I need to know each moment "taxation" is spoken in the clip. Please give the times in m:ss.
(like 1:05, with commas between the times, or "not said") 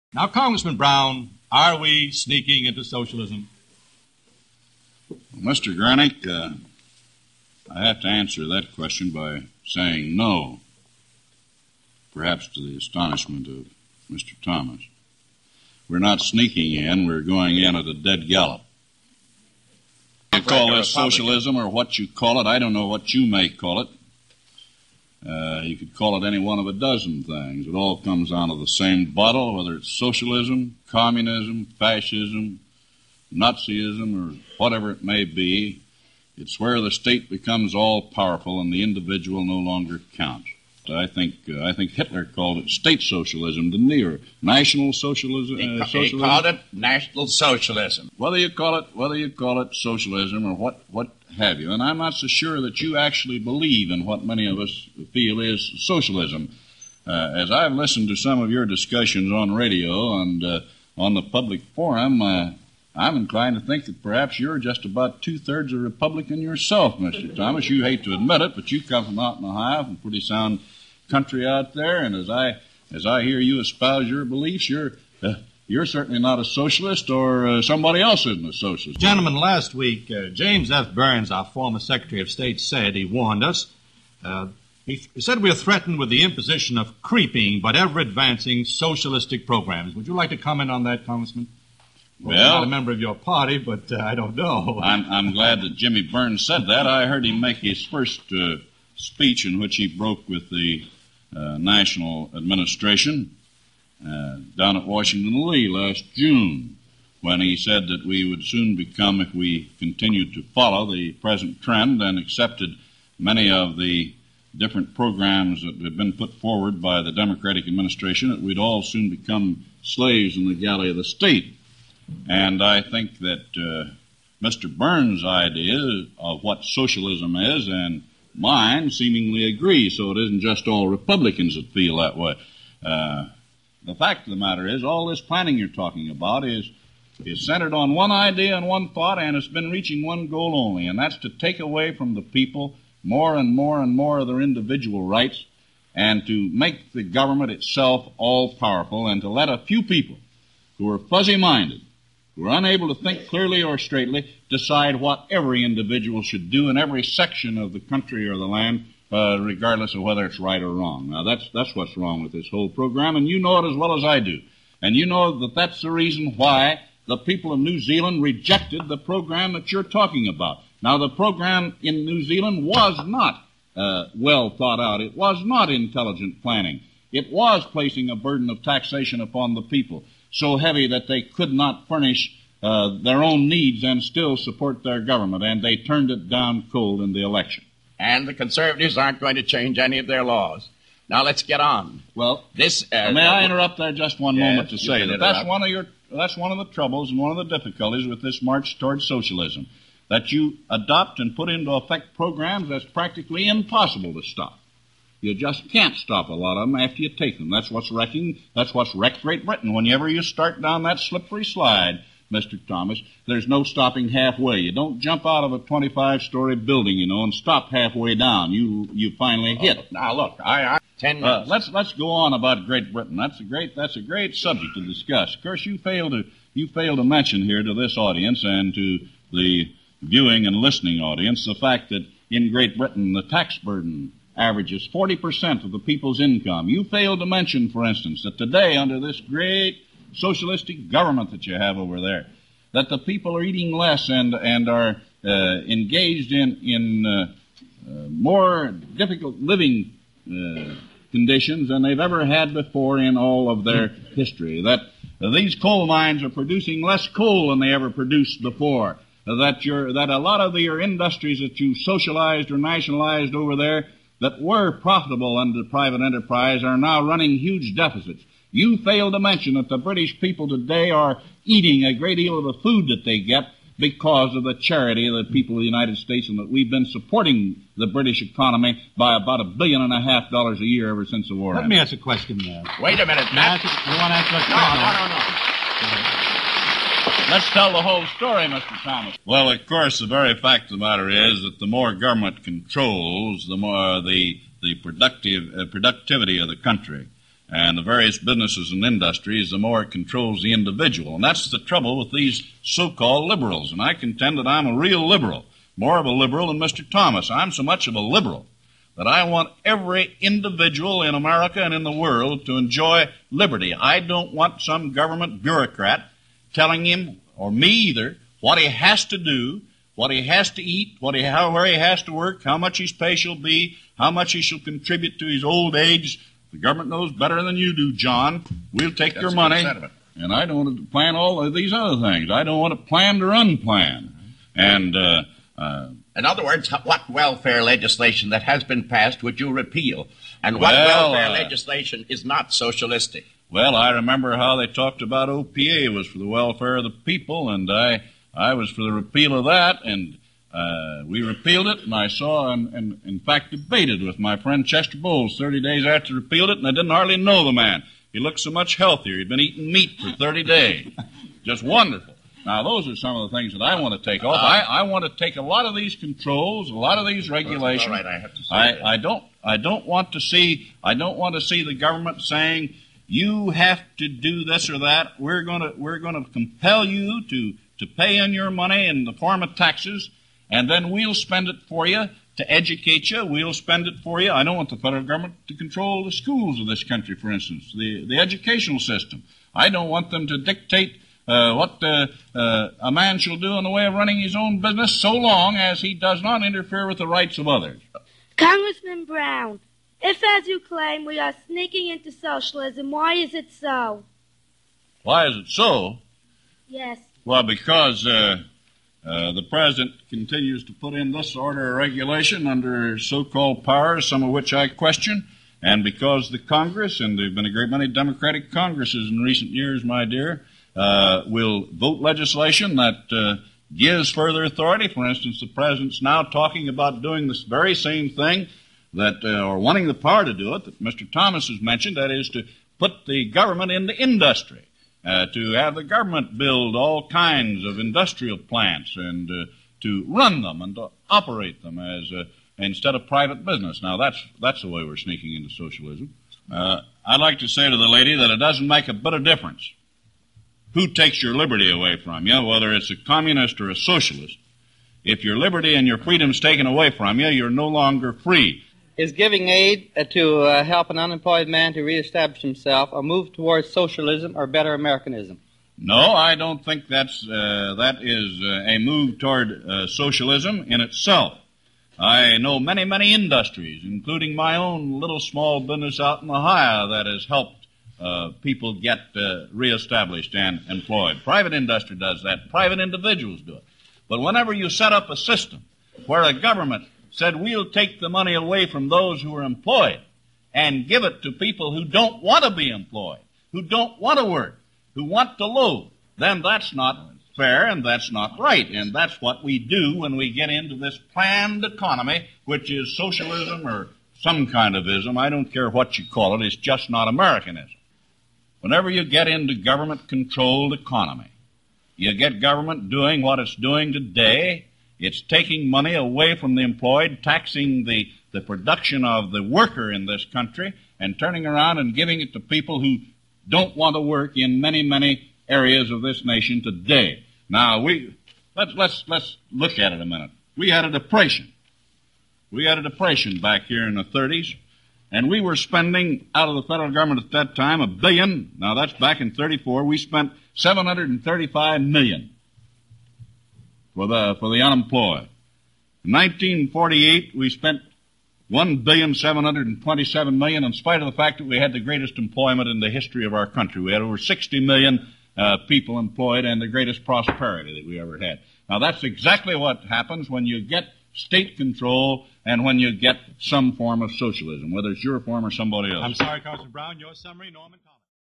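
2:58.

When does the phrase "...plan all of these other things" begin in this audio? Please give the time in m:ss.
5:30.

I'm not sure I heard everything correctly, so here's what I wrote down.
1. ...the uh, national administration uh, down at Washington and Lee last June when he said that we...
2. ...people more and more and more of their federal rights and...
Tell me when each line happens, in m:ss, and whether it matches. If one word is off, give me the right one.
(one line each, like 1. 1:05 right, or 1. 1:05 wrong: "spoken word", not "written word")
1. 1:40 right
2. 2:22 wrong: "individual", not "federal".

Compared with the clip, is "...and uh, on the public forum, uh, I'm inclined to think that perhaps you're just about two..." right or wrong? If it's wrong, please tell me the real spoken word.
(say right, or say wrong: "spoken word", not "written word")
right.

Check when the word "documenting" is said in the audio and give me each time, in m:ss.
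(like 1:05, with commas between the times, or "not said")
not said.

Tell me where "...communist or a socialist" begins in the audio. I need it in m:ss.
7:32.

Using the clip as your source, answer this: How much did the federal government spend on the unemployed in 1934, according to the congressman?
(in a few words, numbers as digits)
735 million.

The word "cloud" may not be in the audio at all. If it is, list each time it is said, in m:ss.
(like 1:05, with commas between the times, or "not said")
not said.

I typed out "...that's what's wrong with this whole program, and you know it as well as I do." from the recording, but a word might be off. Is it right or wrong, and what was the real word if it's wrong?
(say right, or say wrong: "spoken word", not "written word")
right.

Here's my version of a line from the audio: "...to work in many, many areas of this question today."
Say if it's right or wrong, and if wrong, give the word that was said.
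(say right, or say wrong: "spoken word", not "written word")
wrong: "nation", not "question".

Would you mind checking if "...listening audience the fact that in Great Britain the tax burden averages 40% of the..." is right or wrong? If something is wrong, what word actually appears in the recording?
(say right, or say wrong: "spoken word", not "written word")
right.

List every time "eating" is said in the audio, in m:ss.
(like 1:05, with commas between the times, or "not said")
4:03, 4:31, 5:59.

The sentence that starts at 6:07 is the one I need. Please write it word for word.
All right, I have to say I, I don't.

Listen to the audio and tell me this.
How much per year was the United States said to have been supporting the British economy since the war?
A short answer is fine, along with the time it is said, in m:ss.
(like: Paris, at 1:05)
a billion and a half dollars, at 4:39.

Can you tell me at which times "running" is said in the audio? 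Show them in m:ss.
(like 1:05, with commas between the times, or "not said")
4:27, 6:33.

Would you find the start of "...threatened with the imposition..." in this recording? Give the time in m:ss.
1:25.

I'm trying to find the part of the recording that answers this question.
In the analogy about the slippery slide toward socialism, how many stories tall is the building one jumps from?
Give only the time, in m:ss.
3:35.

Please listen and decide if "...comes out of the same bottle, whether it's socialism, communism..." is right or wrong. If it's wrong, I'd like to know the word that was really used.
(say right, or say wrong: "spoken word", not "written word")
right.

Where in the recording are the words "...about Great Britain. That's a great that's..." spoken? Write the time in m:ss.
3:42.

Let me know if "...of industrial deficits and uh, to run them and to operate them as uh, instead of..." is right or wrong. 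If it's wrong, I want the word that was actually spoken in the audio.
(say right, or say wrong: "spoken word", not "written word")
wrong: "plants", not "deficits".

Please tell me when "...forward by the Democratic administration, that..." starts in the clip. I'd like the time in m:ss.
1:56.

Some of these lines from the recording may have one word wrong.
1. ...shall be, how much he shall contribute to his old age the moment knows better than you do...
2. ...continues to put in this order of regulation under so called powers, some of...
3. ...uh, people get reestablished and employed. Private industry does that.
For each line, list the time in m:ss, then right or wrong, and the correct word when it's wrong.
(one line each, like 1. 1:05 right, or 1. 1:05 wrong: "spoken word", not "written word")
1. 5:23 wrong: "government", not "moment"
2. 6:50 right
3. 7:57 right.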